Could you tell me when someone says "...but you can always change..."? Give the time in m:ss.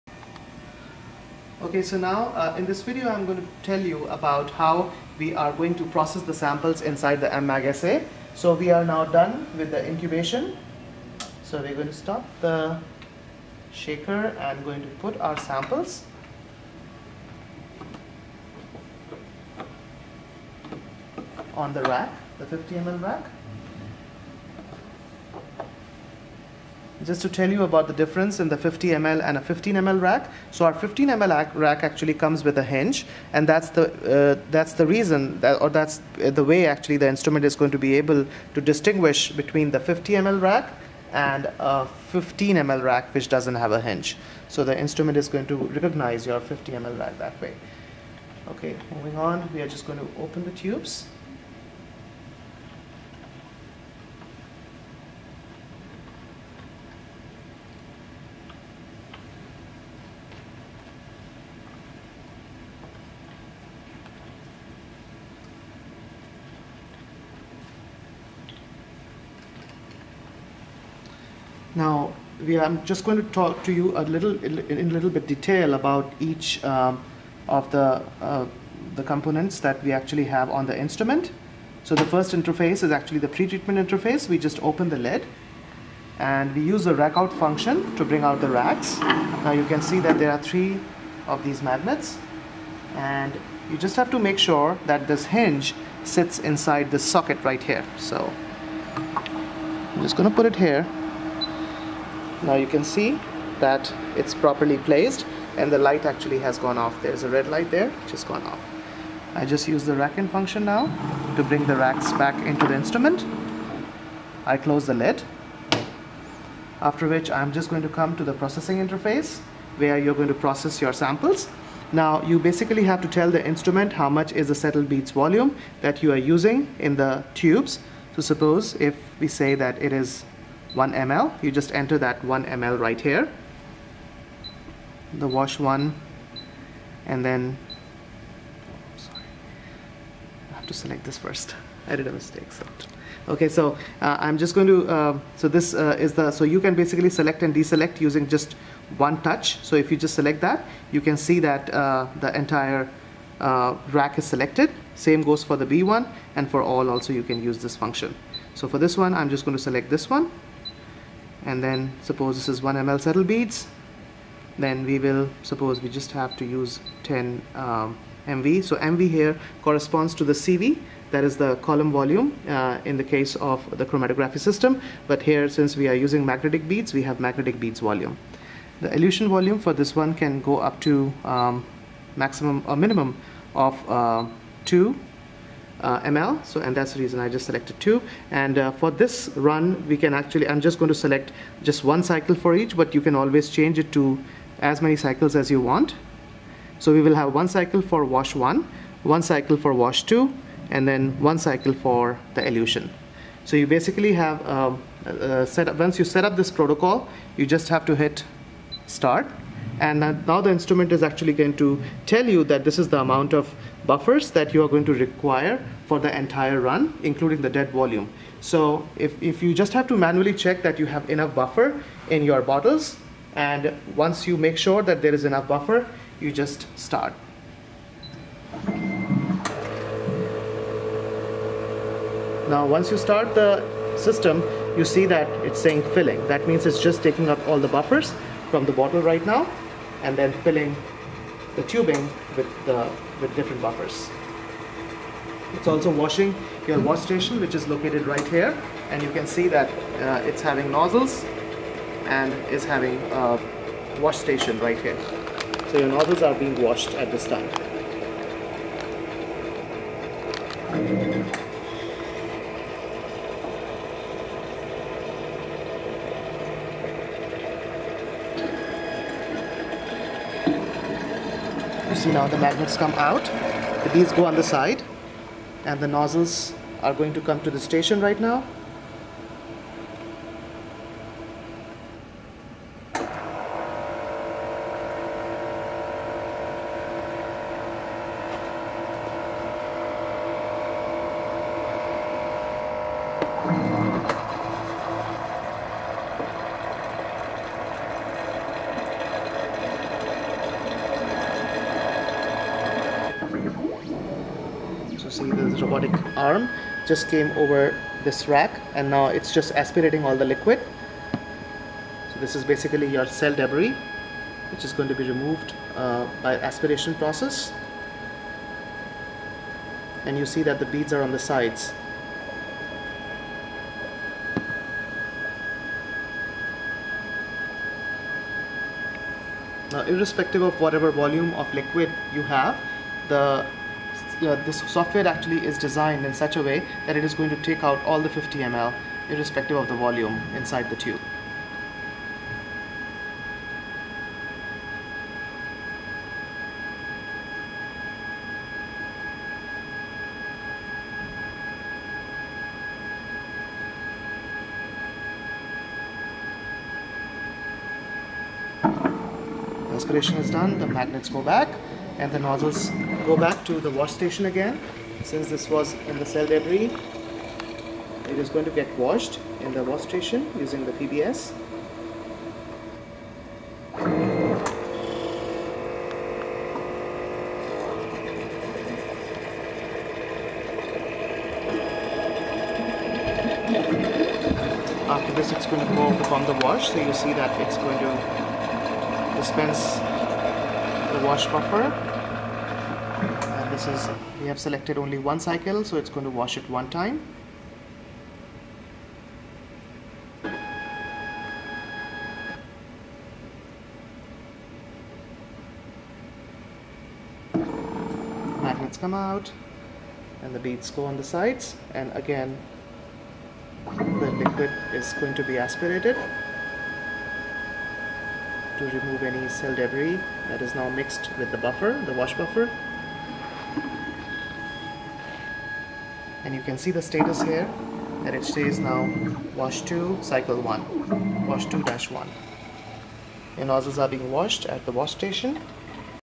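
3:12.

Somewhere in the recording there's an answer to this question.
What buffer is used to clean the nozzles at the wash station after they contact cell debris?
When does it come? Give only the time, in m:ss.
6:10.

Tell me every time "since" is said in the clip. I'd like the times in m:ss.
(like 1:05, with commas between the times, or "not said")
2:55, 6:05.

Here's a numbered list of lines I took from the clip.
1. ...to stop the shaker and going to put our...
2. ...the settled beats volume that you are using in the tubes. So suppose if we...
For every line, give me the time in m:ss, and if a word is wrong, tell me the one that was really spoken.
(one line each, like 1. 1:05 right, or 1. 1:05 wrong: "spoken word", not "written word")
1. 0:11 right
2. 2:04 right.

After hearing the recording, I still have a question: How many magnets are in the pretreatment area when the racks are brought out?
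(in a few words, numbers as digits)
3.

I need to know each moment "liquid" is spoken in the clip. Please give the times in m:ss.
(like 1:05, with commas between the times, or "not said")
5:10, 5:31, 6:54.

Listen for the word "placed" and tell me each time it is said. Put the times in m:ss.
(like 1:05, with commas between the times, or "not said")
1:44.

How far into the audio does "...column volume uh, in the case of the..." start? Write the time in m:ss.
2:51.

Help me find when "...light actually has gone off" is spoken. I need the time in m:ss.
1:45.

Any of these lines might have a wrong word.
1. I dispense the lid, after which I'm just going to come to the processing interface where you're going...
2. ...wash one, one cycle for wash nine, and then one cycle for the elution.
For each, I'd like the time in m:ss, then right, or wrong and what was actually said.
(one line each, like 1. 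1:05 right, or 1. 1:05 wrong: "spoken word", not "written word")
1. 1:54 wrong: "close", not "dispense"
2. 3:18 wrong: "two", not "nine".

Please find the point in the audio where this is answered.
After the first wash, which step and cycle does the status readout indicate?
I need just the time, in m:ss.
7:09.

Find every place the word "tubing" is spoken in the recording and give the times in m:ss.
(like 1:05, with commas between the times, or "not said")
4:01.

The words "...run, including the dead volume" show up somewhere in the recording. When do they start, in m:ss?
3:36.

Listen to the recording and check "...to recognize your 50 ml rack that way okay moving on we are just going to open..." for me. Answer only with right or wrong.
right.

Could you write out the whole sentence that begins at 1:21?
So the first interface is actually the pretreatment interface.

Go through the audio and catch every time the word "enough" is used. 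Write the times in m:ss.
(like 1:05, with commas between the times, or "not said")
3:41, 3:45.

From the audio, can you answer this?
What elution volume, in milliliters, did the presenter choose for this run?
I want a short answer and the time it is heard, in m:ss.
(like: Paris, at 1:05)
2 ml, at 3:04.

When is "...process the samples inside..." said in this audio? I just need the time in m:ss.
0:05.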